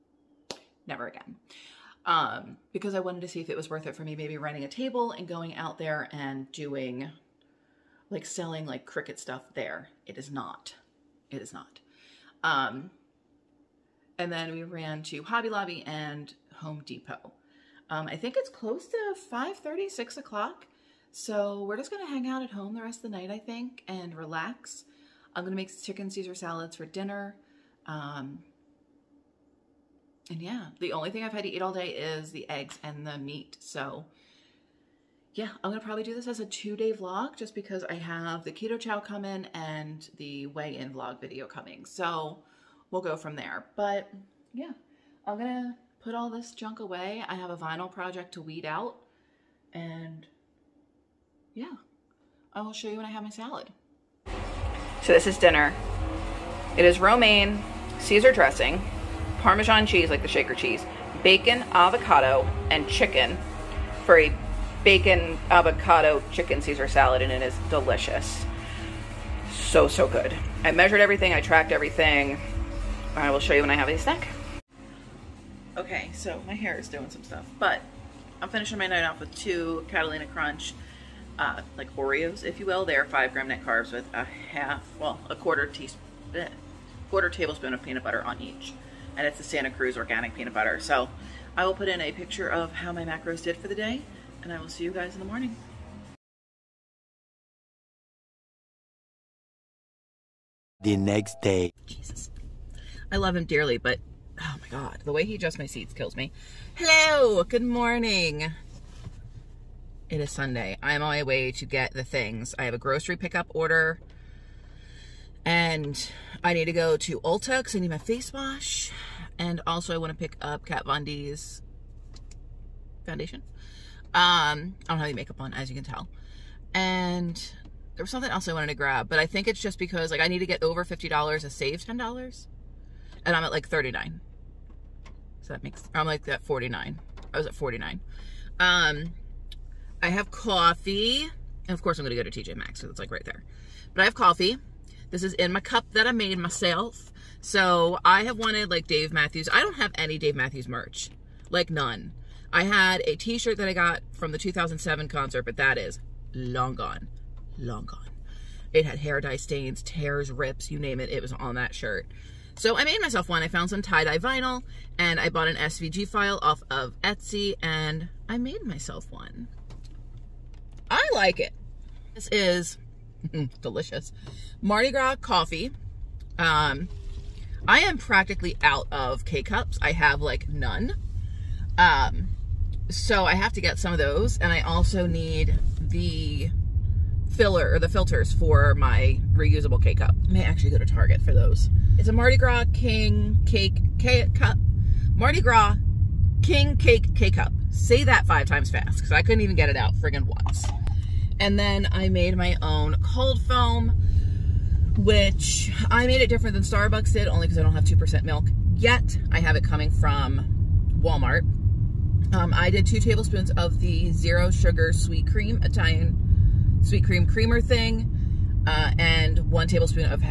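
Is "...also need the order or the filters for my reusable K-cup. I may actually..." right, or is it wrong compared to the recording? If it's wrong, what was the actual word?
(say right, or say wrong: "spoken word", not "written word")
wrong: "filler", not "order".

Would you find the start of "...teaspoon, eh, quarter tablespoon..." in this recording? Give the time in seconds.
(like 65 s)
85 s.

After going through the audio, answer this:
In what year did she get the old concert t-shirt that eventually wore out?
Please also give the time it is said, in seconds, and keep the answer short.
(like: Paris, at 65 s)
2007, at 154 s.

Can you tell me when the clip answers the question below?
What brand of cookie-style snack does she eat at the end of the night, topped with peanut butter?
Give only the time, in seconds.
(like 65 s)
79 s.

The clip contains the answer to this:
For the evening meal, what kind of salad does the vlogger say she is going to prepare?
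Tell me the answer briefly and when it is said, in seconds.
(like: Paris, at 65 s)
Chicken Caesar salads, at 25 s.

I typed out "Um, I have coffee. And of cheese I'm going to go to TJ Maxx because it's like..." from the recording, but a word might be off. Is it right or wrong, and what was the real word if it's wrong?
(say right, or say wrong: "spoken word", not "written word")
wrong: "course", not "cheese".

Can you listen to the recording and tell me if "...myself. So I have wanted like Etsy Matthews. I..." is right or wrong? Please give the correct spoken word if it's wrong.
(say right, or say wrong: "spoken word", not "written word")
wrong: "Dave", not "Etsy".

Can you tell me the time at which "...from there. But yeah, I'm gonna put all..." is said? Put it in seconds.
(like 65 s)
43 s.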